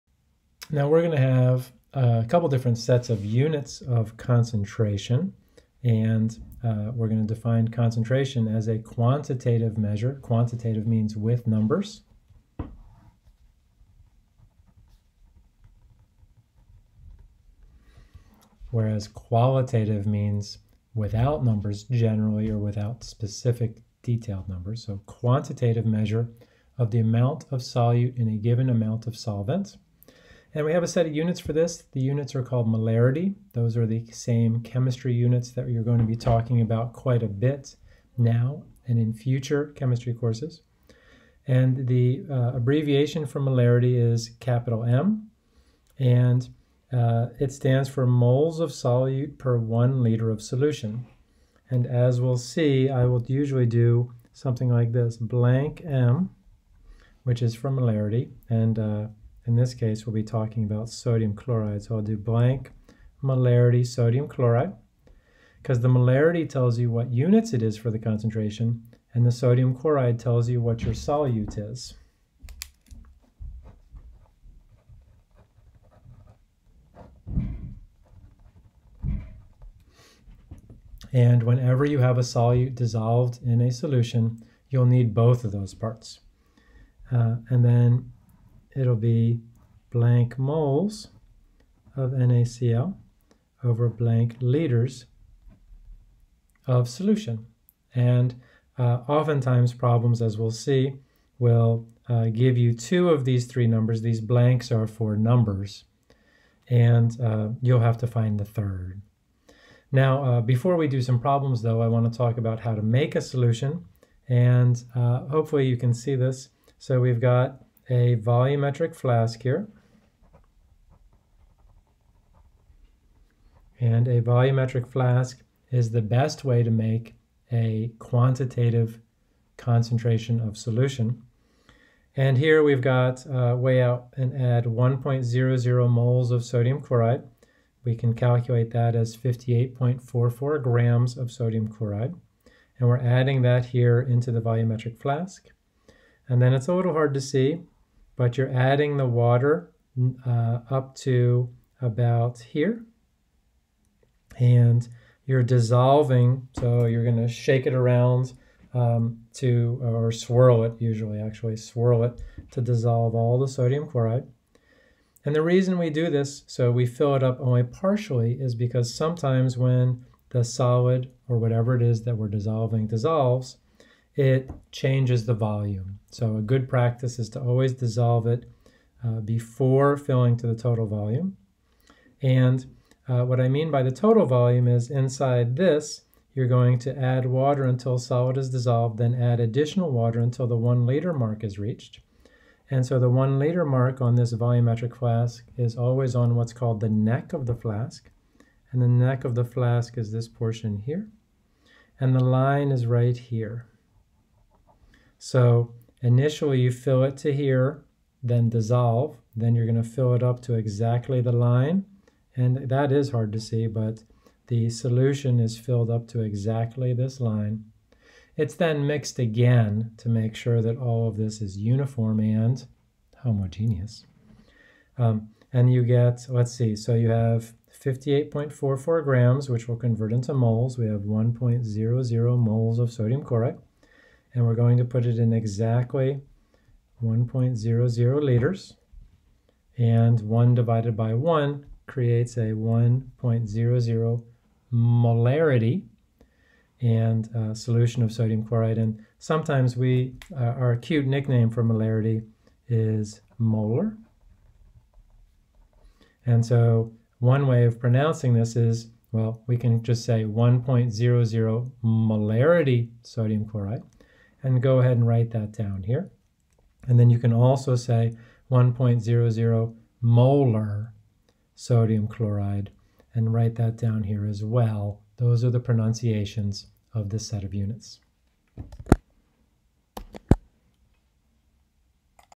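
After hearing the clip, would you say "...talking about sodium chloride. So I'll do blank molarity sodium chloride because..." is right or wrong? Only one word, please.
right.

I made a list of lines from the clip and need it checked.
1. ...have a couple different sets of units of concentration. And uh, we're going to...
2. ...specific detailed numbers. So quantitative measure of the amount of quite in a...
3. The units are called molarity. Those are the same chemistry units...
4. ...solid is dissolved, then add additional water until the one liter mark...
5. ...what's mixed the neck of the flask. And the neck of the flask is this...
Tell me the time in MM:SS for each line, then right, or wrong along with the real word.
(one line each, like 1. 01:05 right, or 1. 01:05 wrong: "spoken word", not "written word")
1. 00:01 right
2. 00:23 wrong: "solute", not "quite"
3. 00:31 right
4. 03:07 right
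5. 03:16 wrong: "called", not "mixed".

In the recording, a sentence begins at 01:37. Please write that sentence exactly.
And uh, oftentimes problems, as we'll see, will uh, give you two of these three numbers.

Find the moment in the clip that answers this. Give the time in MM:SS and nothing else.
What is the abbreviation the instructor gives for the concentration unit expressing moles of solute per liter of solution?
00:44.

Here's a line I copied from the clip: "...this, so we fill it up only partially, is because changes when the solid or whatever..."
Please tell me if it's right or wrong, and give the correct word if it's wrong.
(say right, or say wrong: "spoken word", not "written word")
wrong: "sometimes", not "changes".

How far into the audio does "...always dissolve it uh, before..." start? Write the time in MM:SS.
02:57.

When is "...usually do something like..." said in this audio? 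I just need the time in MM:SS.
00:53.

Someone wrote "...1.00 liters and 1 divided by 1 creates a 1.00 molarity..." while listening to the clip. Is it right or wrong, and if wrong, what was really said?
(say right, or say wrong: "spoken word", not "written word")
right.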